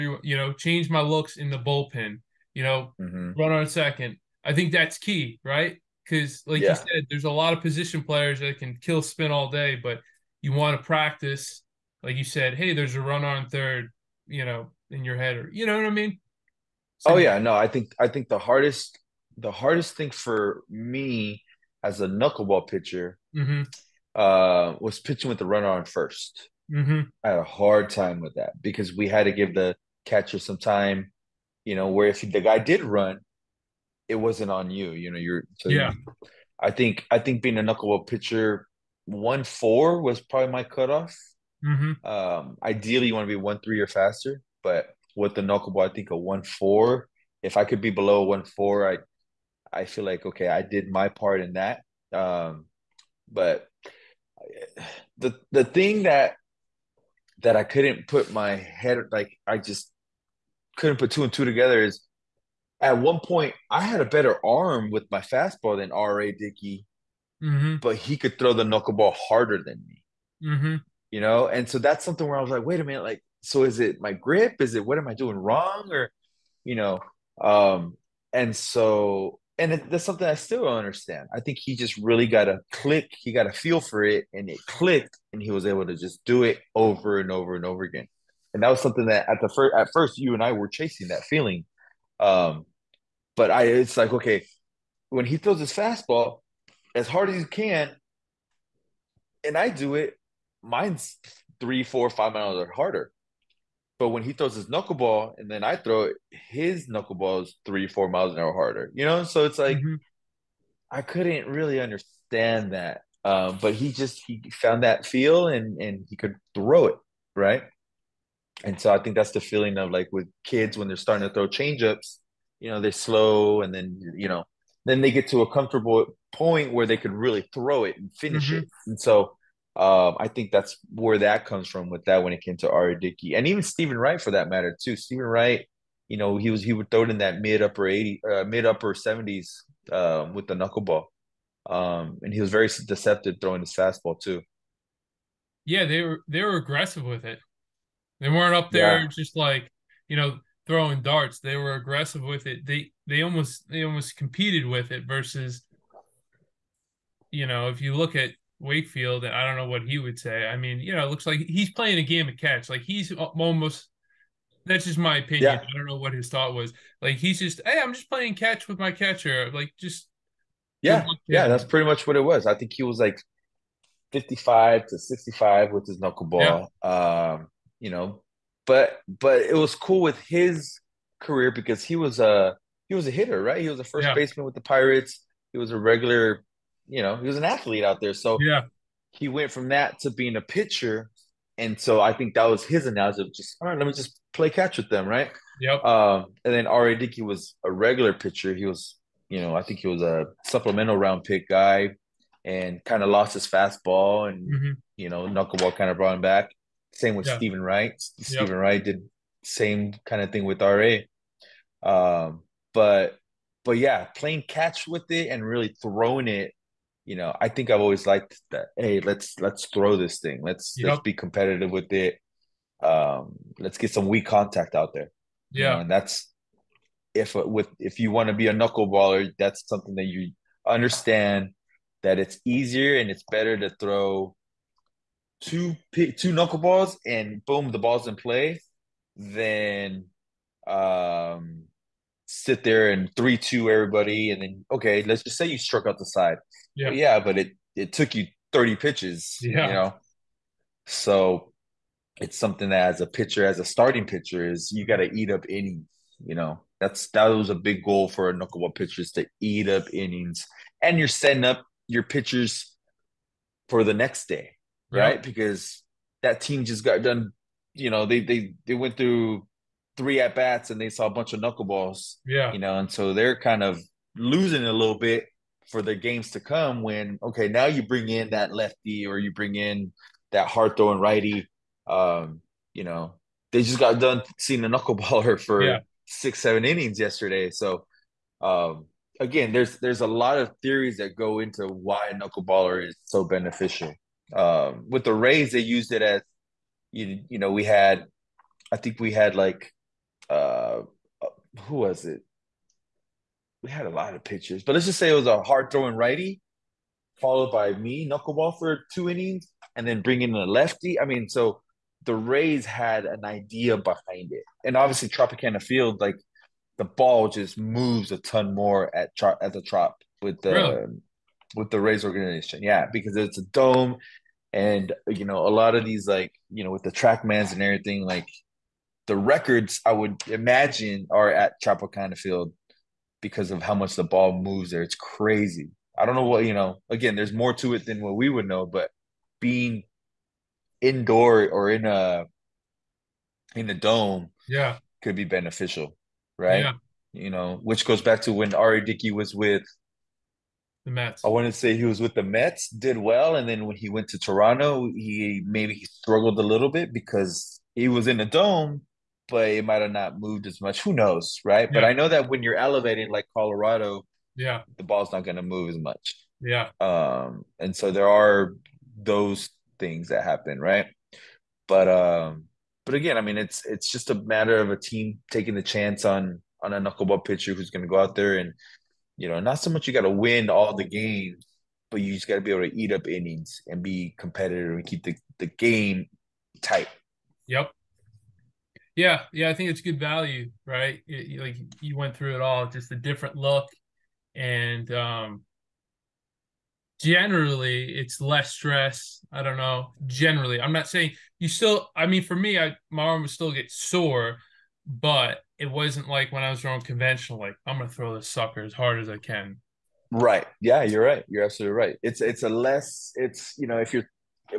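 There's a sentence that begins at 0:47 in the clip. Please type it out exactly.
If I could be below one four, I I feel like okay, I did my part in that.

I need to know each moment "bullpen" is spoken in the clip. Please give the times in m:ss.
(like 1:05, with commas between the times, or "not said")
0:01.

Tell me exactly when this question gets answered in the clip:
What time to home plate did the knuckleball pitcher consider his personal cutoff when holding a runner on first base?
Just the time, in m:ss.
0:39.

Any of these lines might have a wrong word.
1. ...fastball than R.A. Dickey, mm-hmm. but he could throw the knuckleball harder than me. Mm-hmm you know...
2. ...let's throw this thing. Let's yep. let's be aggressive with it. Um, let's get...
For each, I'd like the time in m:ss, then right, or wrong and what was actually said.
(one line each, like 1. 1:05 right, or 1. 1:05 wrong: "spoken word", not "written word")
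1. 1:05 right
2. 3:39 wrong: "competitive", not "aggressive".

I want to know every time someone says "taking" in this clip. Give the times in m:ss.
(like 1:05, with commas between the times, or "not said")
6:15.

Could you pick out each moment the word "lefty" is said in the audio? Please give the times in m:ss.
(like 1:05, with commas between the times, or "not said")
4:38, 5:10.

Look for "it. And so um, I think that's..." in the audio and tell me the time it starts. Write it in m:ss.
2:08.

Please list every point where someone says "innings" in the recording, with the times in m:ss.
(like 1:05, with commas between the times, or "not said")
4:15, 4:19, 4:46, 5:09, 6:23.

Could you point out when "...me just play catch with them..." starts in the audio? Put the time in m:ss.
3:13.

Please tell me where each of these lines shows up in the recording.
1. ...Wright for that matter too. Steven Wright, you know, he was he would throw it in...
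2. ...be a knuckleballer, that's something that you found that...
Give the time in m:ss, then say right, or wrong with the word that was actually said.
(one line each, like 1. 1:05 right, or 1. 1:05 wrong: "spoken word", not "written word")
1. 2:13 right
2. 3:48 wrong: "understand", not "found".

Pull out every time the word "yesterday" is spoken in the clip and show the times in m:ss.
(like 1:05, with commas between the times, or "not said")
4:46.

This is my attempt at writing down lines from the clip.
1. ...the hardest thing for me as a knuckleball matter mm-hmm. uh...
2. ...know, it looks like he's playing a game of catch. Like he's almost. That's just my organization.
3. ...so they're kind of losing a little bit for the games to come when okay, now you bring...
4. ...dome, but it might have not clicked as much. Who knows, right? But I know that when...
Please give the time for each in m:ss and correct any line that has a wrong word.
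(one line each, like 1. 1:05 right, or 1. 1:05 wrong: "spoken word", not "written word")
1. 0:19 wrong: "pitcher", not "matter"
2. 2:40 wrong: "opinion", not "organization"
3. 4:32 right
4. 5:58 wrong: "moved", not "clicked".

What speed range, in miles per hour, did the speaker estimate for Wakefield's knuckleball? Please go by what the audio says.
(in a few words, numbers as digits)
55 to 65.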